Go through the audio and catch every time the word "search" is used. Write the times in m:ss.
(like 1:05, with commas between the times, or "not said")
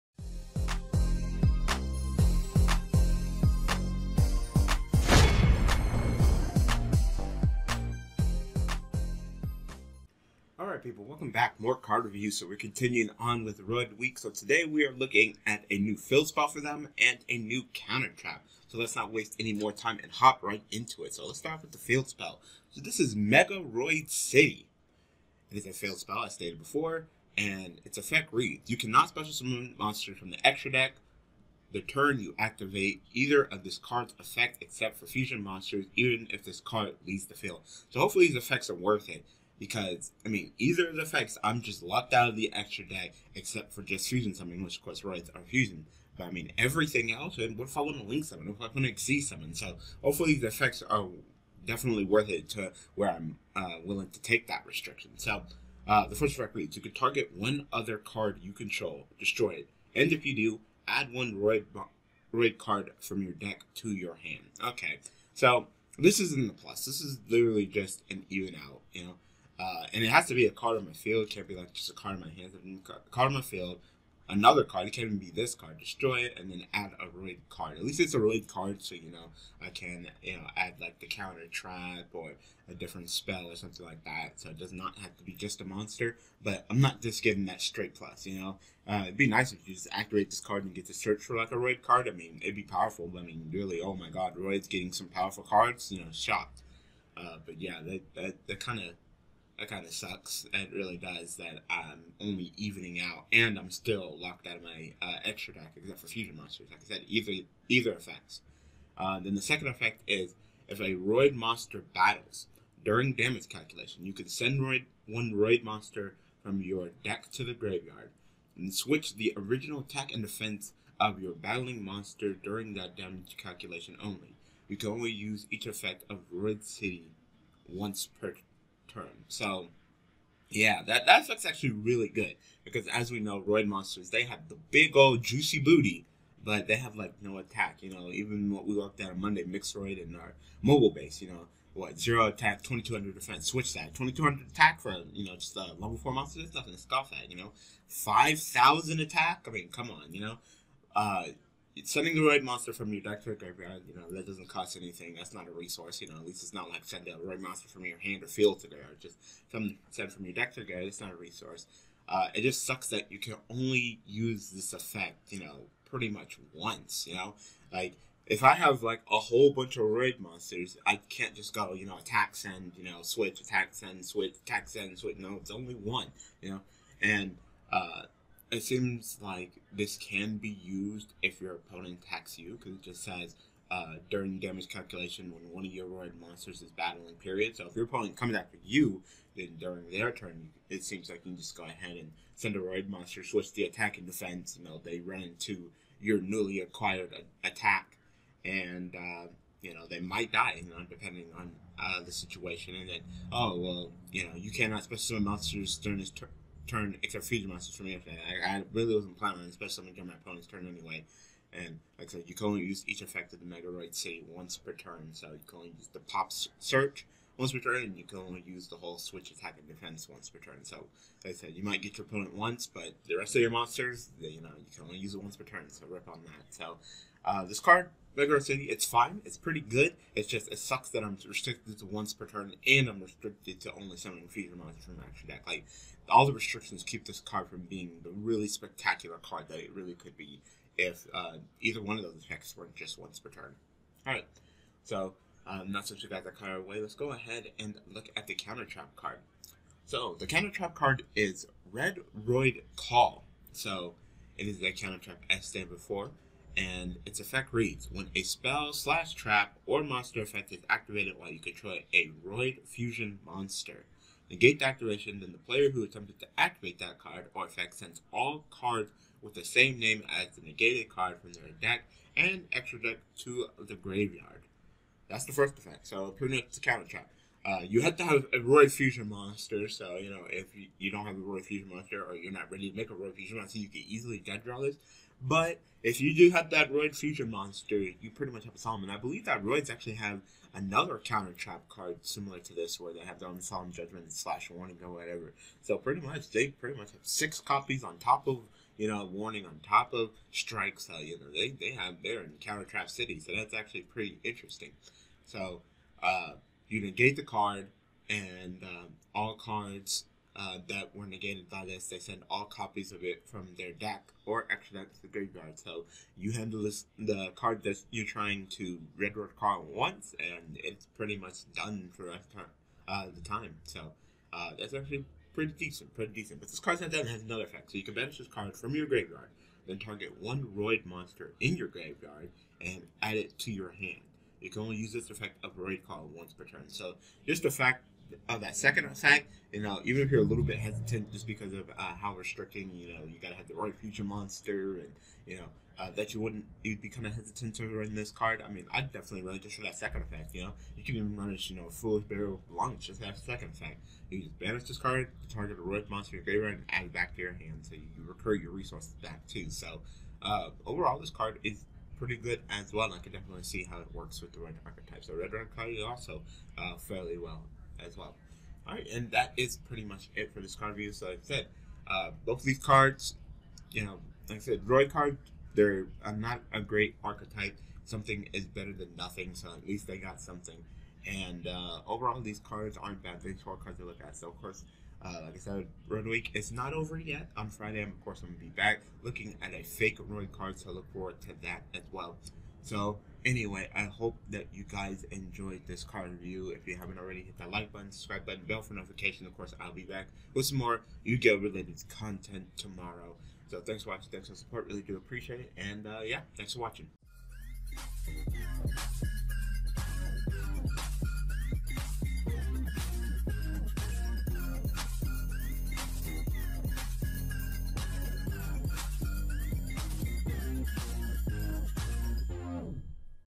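1:30, 3:36.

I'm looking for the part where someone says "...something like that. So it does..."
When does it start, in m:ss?
1:23.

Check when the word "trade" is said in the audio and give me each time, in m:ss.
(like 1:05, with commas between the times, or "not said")
not said.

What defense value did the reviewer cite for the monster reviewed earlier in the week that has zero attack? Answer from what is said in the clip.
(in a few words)
2200.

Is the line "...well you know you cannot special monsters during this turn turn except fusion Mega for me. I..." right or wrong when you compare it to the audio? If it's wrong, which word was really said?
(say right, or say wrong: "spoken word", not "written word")
wrong: "Monsters", not "Mega".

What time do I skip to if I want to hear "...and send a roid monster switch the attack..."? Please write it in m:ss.
3:11.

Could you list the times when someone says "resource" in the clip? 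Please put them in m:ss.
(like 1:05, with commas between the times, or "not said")
2:35, 2:41, 5:58.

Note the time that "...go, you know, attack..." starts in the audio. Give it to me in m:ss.
2:51.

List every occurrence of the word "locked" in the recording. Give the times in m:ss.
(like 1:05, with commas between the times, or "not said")
0:41, 1:44.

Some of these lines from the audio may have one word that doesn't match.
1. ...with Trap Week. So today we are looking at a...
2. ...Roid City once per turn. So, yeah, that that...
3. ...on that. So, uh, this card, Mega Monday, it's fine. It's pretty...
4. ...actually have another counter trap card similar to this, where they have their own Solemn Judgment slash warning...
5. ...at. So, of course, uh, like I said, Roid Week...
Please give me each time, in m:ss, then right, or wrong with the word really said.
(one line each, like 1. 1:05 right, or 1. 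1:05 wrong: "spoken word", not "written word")
1. 0:13 wrong: "Roid", not "Trap"
2. 2:06 right
3. 3:46 wrong: "City", not "Monday"
4. 4:49 right
5. 6:24 right.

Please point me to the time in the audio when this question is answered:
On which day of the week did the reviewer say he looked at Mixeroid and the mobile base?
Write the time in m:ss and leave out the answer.
2:19.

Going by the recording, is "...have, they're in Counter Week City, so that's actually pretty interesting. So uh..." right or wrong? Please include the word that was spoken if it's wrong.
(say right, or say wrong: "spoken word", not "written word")
wrong: "Trap", not "Week".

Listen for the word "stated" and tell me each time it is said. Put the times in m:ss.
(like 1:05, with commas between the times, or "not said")
0:26, 4:15.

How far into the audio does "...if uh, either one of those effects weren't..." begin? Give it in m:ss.
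4:00.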